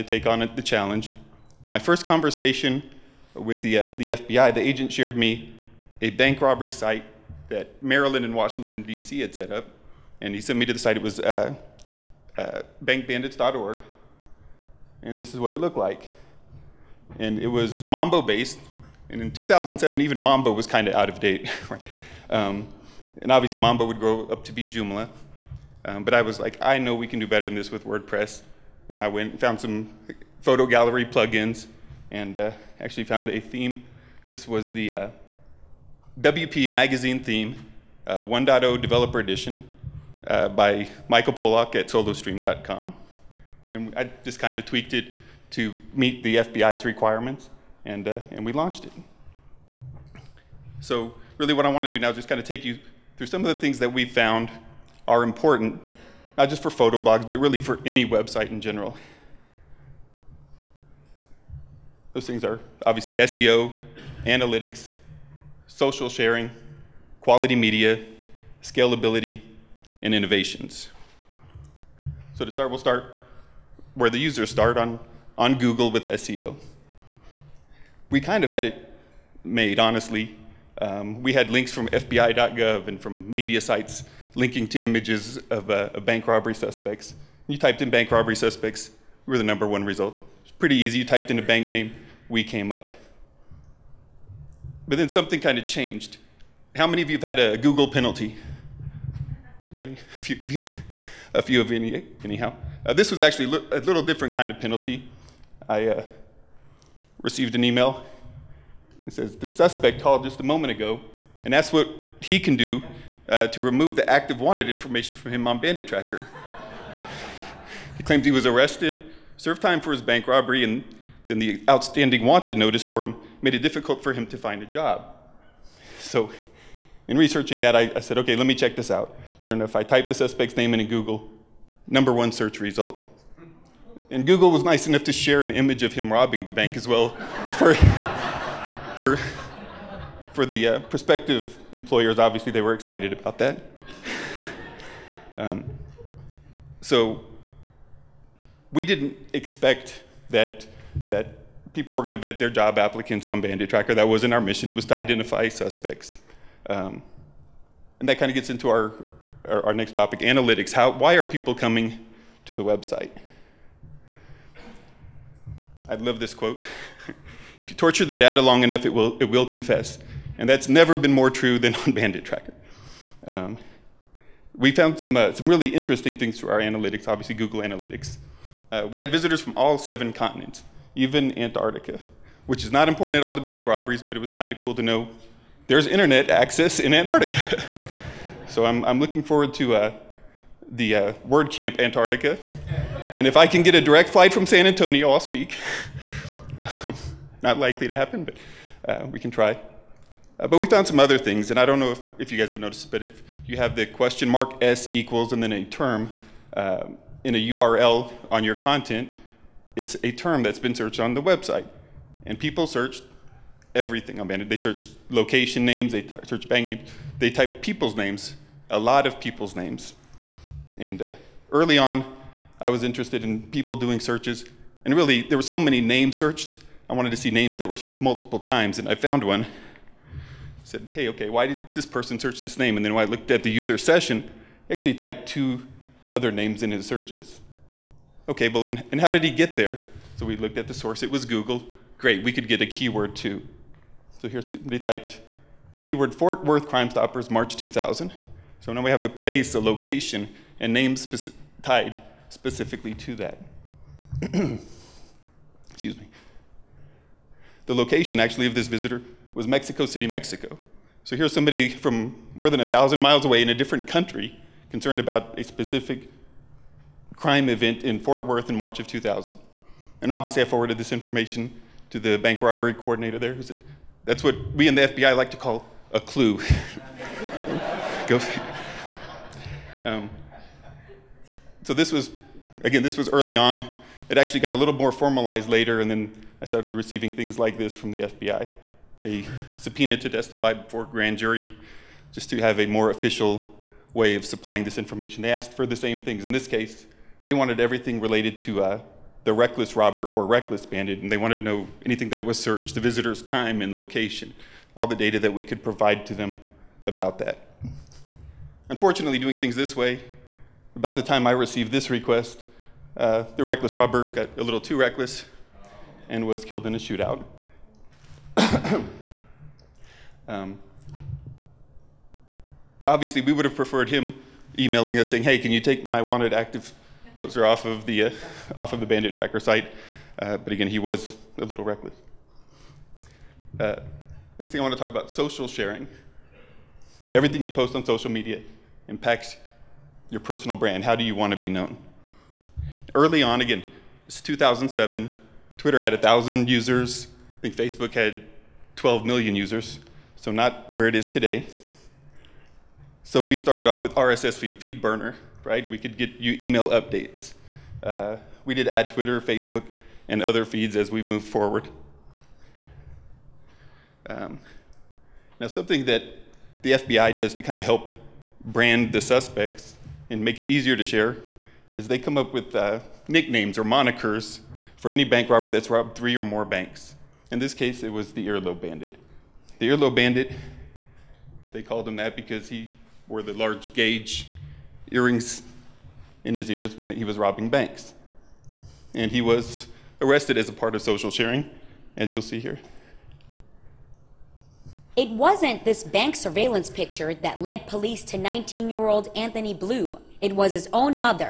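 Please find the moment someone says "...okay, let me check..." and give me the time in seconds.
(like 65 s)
128 s.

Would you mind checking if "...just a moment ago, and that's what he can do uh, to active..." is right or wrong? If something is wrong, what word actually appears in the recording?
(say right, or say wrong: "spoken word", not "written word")
wrong: "remove", not "active".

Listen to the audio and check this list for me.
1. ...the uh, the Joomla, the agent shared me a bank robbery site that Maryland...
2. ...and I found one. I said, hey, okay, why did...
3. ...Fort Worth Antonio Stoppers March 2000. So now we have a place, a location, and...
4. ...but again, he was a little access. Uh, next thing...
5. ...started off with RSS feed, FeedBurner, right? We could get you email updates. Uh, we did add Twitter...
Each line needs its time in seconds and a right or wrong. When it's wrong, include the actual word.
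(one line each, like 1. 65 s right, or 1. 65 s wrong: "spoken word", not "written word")
1. 3 s wrong: "FBI", not "Joomla"
2. 228 s right
3. 246 s wrong: "Crime", not "Antonio"
4. 330 s wrong: "reckless", not "access"
5. 353 s right.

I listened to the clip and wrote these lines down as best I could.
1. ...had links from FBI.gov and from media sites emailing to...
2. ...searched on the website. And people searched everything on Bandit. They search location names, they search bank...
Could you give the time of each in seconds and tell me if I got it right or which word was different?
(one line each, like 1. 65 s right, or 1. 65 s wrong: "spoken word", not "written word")
1. 81 s wrong: "linking", not "emailing"
2. 210 s right.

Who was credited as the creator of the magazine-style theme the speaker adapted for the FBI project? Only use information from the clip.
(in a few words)
Michael Pollock.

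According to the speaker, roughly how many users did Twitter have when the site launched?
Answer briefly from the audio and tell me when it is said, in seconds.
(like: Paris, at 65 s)
1,000, at 345 s.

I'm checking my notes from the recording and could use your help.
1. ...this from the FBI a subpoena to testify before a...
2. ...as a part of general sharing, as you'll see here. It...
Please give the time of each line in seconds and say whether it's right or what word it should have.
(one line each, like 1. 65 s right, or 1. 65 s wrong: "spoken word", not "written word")
1. 287 s right
2. 390 s wrong: "social", not "general".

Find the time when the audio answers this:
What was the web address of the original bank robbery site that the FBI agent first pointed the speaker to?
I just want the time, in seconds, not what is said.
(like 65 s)
12 s.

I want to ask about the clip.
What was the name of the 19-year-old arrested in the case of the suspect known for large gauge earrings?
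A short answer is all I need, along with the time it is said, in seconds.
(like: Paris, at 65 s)
Anthony Blue, at 399 s.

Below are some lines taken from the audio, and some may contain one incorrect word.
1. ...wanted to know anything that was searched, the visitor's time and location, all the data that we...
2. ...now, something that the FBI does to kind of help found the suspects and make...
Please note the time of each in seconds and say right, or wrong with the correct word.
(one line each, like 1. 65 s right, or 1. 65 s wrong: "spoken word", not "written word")
1. 301 s right
2. 365 s wrong: "brand", not "found".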